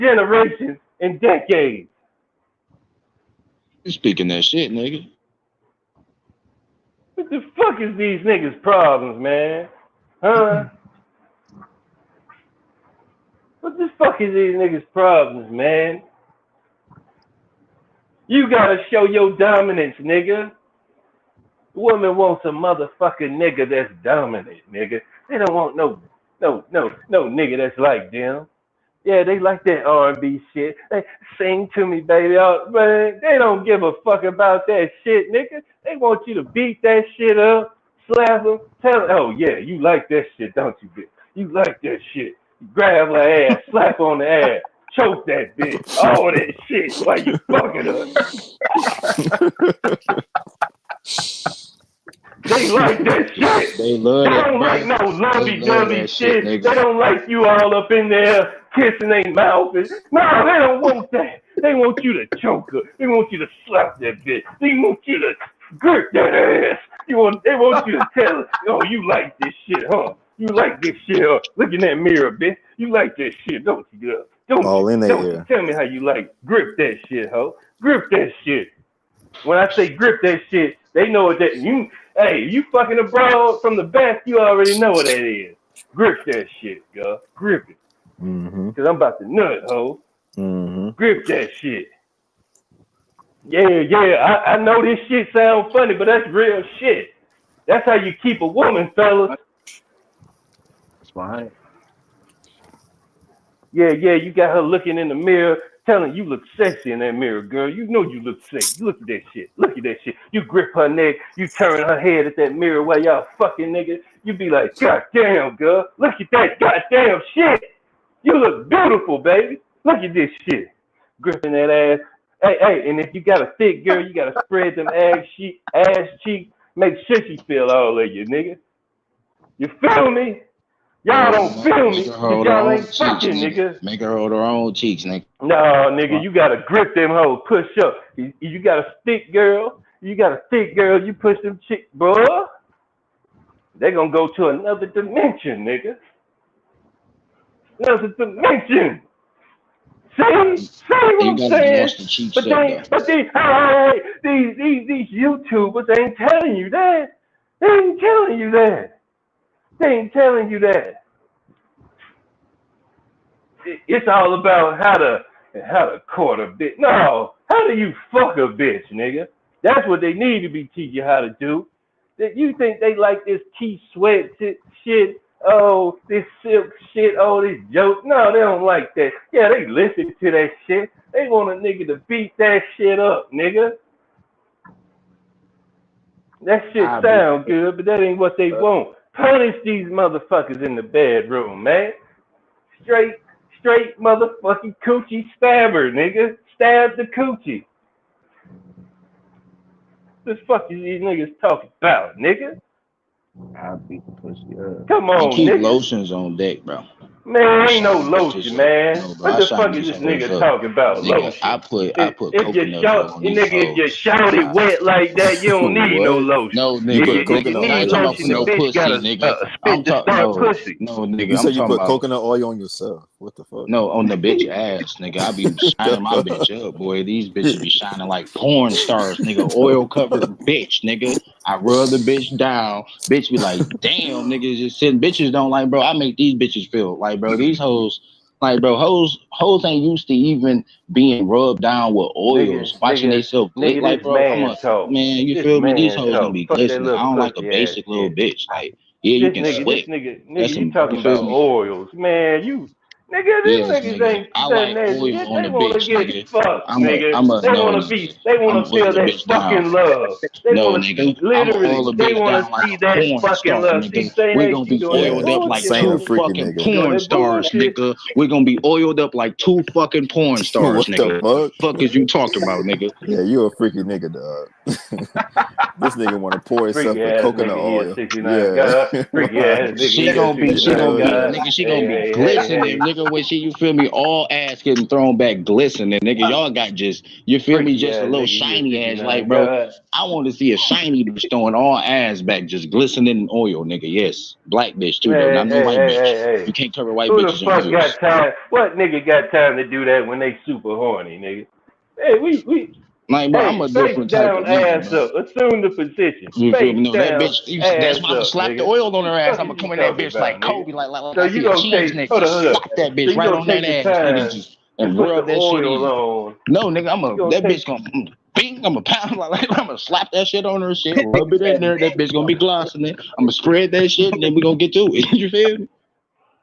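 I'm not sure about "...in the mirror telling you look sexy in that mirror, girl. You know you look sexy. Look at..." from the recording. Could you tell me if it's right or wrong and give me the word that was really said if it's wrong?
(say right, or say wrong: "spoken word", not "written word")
right.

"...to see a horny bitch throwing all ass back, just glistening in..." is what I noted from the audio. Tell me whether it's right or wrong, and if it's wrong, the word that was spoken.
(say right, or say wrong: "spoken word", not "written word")
wrong: "shiny", not "horny".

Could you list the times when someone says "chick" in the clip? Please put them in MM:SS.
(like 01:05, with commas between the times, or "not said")
02:21.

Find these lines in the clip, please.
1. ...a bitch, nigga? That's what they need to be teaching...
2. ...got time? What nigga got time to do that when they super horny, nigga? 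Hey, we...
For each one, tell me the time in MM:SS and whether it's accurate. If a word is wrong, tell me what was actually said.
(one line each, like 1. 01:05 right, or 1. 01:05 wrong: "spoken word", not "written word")
1. 02:48 right
2. 04:57 right.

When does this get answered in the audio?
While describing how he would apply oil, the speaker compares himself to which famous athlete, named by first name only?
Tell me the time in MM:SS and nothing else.
05:10.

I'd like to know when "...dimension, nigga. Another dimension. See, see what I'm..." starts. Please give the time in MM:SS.
02:24.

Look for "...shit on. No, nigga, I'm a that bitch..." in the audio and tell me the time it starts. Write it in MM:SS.
05:15.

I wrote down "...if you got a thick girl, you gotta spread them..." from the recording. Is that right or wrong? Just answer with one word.
right.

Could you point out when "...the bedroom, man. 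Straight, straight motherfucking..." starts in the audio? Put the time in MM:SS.
03:10.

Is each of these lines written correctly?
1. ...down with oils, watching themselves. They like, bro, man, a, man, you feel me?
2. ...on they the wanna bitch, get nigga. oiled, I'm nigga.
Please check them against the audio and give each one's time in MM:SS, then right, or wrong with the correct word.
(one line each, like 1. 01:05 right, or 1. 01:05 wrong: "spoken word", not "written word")
1. 04:01 right
2. 04:15 wrong: "fucked", not "oiled".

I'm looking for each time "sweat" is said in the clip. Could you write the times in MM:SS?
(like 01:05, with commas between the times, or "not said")
02:53, 04:09.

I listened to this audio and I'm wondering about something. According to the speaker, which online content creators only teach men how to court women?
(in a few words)
YouTubers.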